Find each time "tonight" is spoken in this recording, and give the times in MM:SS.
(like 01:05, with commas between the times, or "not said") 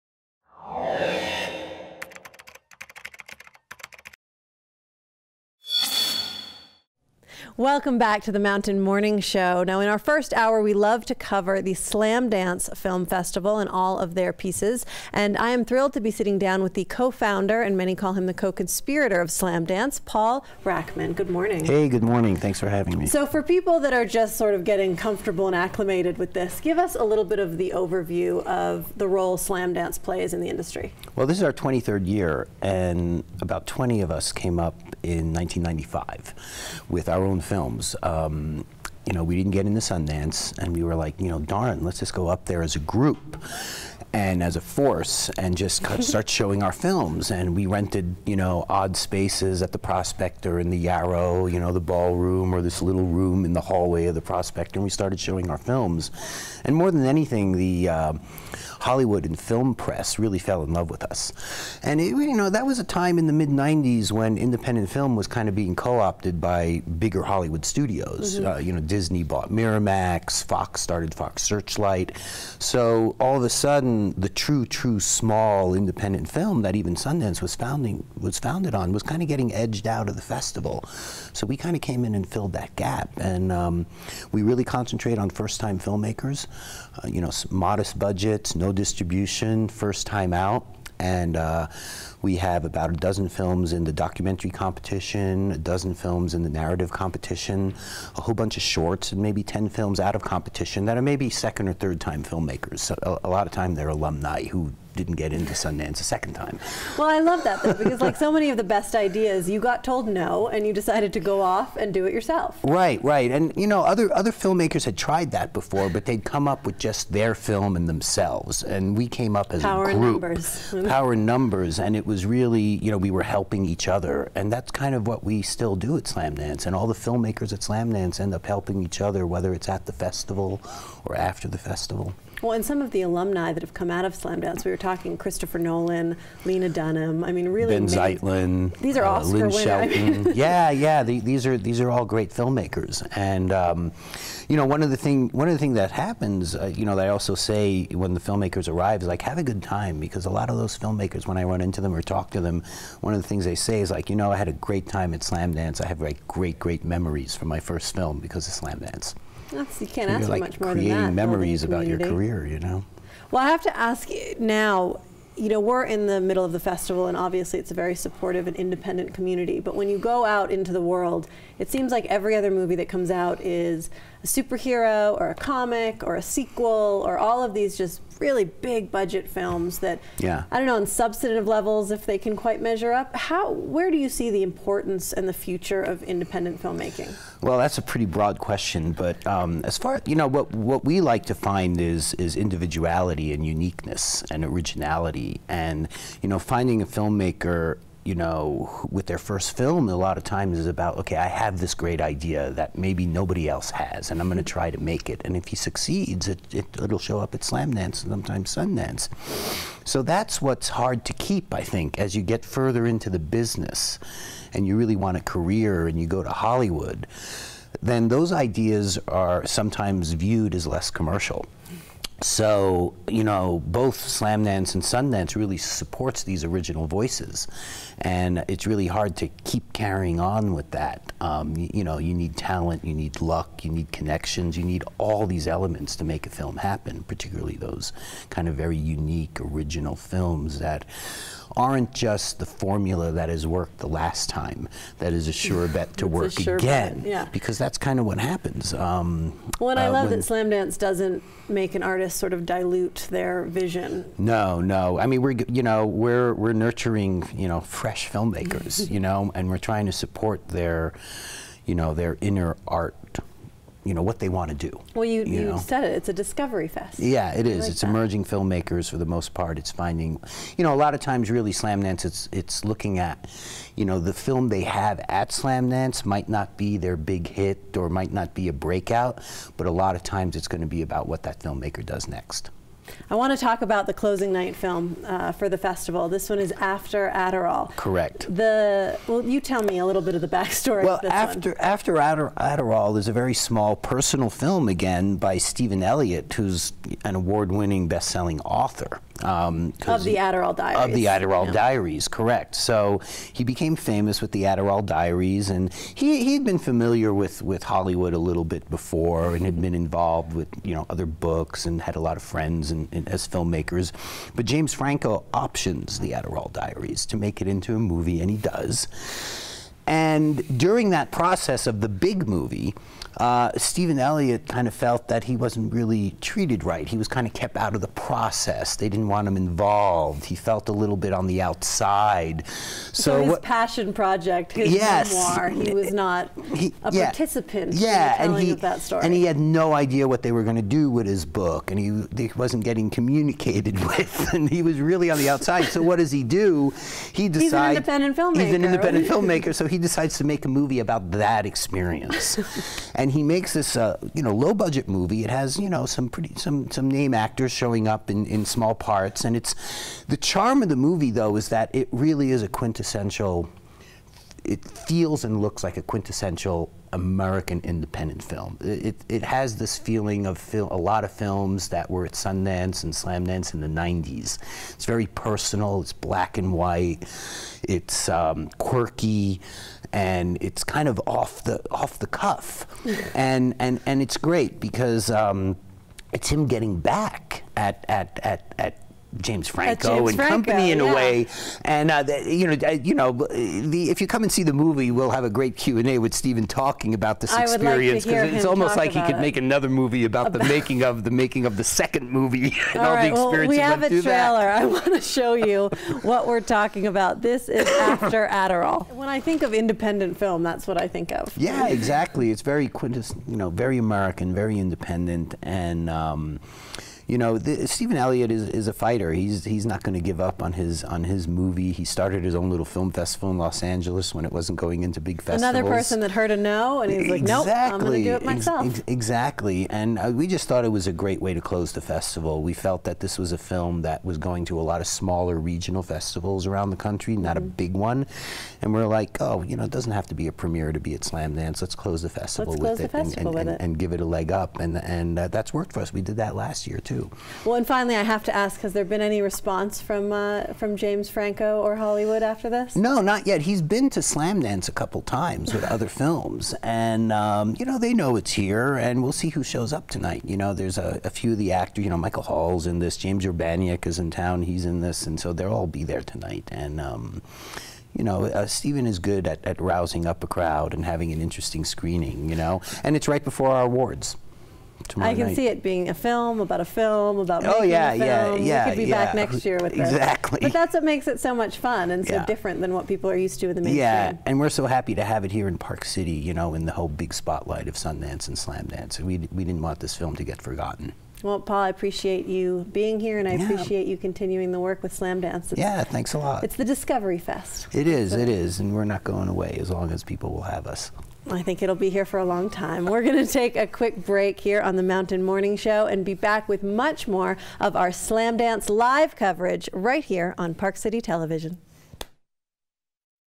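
07:39, 07:46.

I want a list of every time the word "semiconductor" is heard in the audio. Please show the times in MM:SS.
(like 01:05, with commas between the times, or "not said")
not said.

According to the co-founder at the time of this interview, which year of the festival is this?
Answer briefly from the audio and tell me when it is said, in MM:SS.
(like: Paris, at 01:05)
23rd, at 00:31.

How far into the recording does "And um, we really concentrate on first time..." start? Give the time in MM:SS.
01:23.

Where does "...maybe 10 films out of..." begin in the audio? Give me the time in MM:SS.
01:39.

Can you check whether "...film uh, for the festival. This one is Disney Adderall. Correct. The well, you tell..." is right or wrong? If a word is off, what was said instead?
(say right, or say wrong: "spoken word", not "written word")
wrong: "After", not "Disney".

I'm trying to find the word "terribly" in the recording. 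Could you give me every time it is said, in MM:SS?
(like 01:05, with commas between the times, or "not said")
not said.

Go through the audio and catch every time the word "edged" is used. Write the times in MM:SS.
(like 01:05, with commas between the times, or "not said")
01:19.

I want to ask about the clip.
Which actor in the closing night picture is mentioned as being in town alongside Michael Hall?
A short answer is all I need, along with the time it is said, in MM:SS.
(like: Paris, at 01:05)
James Urbaniak, at 07:42.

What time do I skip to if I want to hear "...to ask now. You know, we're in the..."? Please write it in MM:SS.
02:43.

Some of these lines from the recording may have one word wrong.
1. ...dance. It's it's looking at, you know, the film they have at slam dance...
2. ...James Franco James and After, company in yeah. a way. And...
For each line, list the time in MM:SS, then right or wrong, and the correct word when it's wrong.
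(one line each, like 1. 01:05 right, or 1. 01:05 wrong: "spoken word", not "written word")
1. 04:31 right
2. 06:29 wrong: "Franco", not "After".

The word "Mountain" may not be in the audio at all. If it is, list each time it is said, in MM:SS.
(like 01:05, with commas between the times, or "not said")
00:08, 08:24.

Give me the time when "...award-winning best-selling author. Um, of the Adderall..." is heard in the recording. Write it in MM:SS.
04:57.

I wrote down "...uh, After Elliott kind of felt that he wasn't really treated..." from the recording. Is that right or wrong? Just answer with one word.
wrong.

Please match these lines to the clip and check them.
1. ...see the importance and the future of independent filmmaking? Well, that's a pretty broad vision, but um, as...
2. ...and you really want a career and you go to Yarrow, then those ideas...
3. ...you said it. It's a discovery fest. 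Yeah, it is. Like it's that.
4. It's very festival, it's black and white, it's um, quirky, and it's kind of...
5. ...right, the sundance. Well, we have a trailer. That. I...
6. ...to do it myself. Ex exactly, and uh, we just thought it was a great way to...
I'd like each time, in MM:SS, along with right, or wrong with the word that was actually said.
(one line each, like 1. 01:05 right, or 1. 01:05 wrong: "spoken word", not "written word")
1. 03:04 wrong: "question", not "vision"
2. 03:34 wrong: "Hollywood", not "Yarrow"
3. 04:25 right
4. 06:14 wrong: "personal", not "festival"
5. 06:42 wrong: "experience", not "sundance"
6. 07:08 right.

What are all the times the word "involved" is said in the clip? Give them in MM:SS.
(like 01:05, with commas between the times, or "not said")
05:09, 05:29.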